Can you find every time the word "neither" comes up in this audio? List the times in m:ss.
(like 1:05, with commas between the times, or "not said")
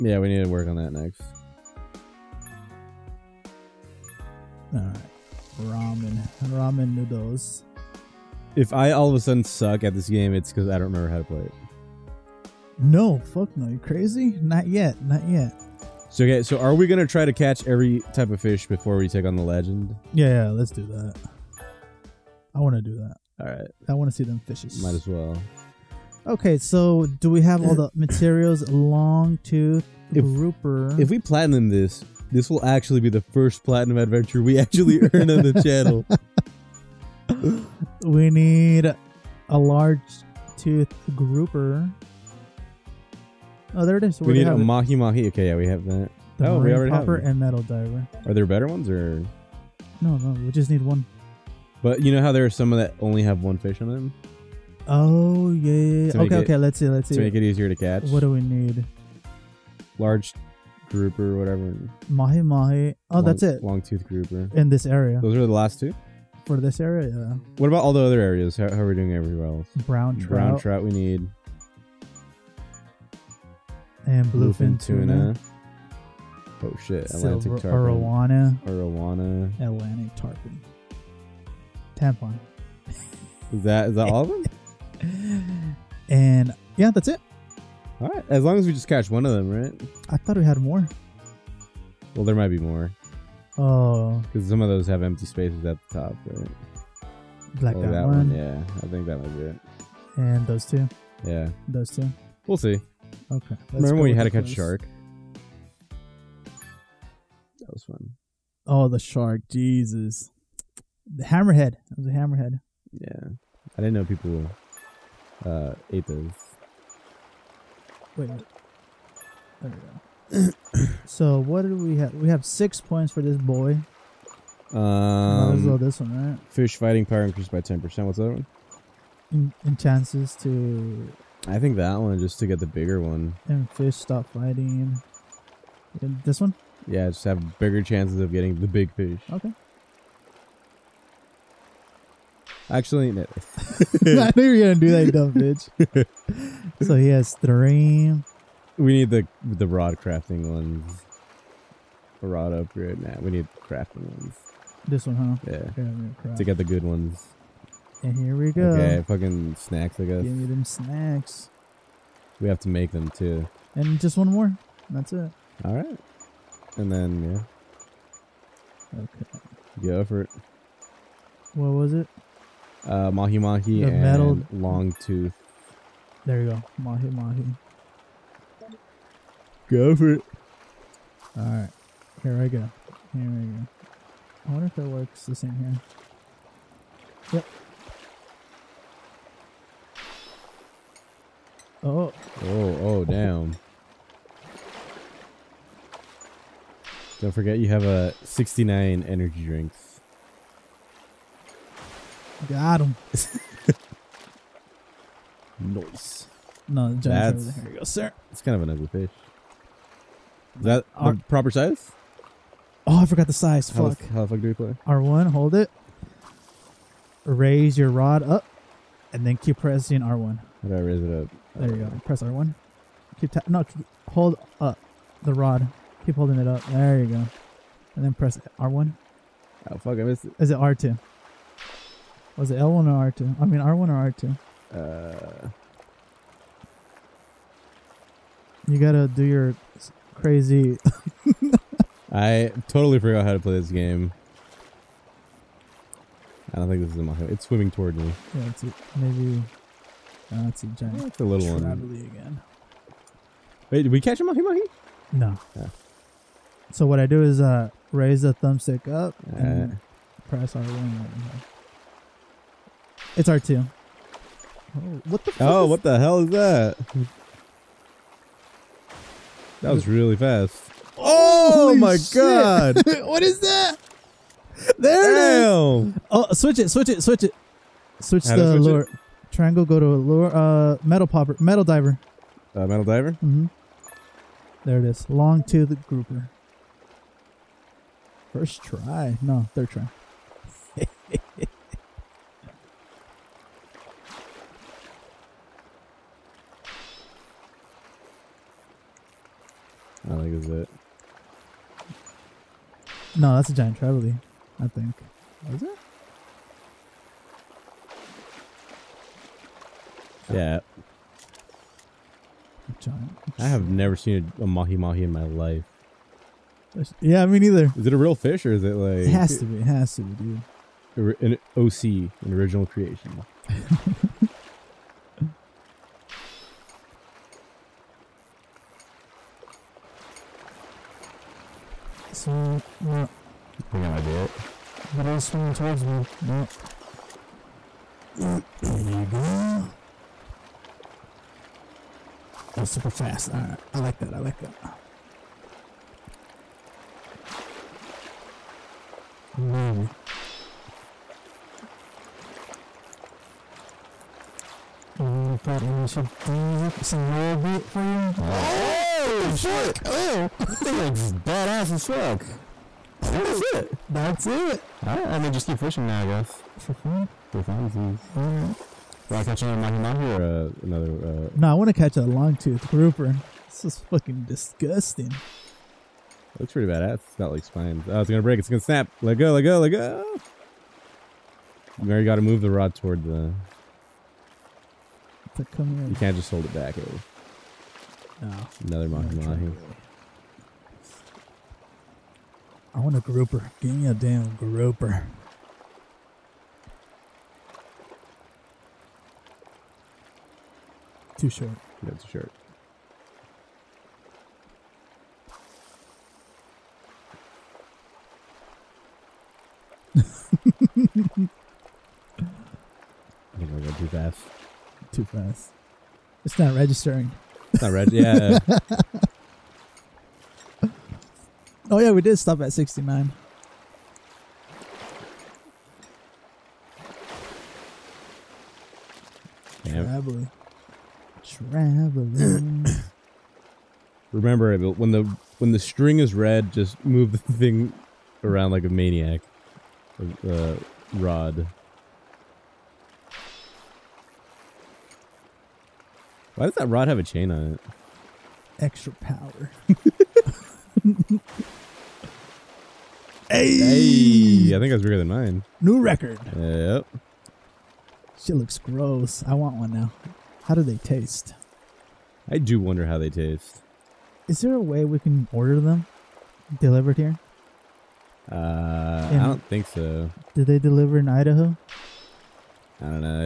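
5:17.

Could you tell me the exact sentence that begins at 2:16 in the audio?
Yeah, just have bigger chances of getting the big fish.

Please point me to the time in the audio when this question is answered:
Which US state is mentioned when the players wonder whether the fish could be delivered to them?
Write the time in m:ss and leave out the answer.
7:51.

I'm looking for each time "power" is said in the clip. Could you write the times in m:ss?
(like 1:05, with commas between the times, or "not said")
2:07, 7:29.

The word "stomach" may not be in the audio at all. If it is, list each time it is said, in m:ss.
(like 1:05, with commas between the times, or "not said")
not said.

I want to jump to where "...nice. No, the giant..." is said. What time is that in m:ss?
3:25.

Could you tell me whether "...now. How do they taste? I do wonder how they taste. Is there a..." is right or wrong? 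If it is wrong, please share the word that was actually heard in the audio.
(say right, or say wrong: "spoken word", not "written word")
right.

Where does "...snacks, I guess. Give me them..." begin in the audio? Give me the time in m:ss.
2:39.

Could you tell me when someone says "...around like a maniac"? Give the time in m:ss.
7:18.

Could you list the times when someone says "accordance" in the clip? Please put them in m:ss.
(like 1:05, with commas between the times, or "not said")
not said.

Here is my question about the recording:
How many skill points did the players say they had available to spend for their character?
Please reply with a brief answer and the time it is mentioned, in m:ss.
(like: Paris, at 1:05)
6, at 2:02.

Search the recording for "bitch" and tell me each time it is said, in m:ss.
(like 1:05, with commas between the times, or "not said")
2:25.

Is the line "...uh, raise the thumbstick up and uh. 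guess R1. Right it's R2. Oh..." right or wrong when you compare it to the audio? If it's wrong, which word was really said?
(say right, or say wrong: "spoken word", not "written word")
wrong: "press", not "guess".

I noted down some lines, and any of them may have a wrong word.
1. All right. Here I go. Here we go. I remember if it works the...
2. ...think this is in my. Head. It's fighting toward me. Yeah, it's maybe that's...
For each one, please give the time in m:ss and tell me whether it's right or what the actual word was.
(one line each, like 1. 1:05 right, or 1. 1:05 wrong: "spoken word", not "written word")
1. 3:01 wrong: "wonder", not "remember"
2. 4:06 wrong: "swimming", not "fighting".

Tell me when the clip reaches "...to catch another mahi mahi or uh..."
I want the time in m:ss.
6:09.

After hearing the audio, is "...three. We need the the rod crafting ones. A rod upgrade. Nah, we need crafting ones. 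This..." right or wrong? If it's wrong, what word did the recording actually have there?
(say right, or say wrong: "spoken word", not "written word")
right.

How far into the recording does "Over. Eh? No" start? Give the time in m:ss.
6:26.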